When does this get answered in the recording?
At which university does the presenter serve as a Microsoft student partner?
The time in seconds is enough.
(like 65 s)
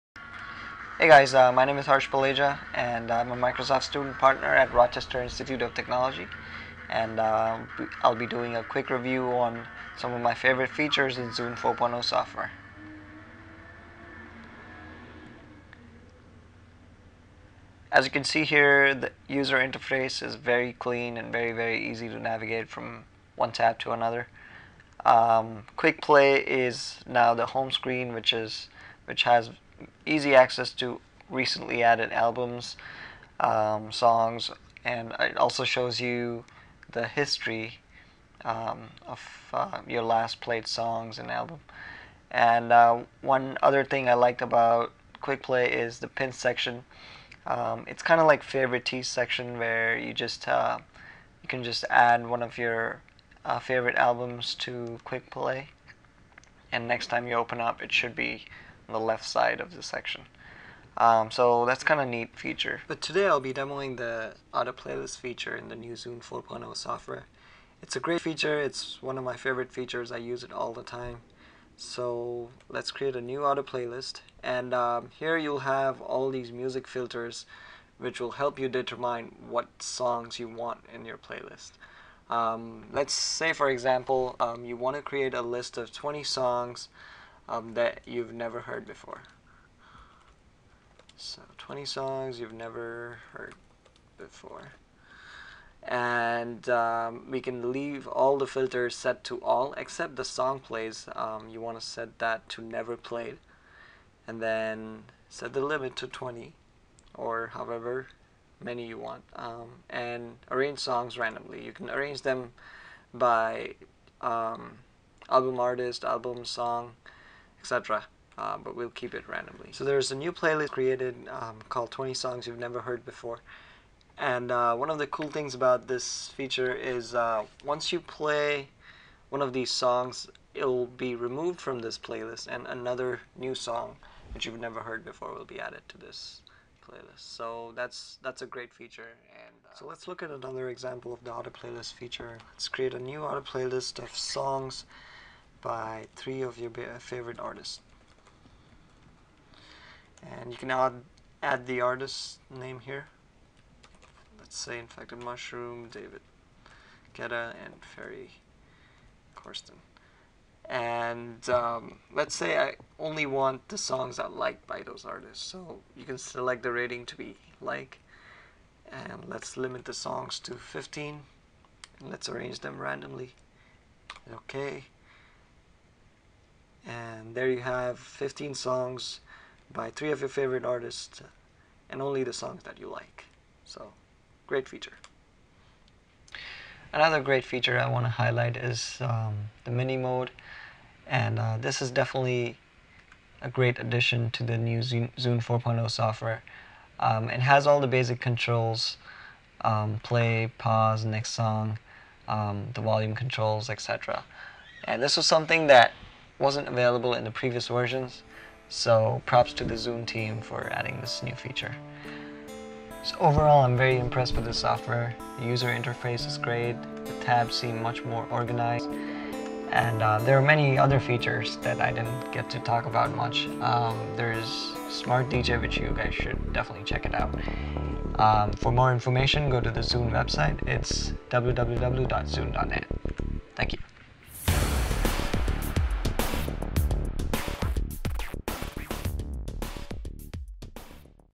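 4 s.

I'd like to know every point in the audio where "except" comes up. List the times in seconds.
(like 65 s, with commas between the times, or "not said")
99 s.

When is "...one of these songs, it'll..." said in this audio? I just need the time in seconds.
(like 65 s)
129 s.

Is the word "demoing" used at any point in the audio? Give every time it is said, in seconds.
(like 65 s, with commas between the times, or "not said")
63 s.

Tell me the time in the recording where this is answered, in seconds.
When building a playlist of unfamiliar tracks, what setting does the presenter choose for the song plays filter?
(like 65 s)
102 s.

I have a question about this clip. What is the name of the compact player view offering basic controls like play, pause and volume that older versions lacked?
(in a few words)
Mini mode.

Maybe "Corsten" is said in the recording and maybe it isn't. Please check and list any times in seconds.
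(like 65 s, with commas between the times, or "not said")
159 s.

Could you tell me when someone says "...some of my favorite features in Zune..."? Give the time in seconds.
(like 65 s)
9 s.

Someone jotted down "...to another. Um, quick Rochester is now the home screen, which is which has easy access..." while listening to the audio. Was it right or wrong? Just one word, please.
wrong.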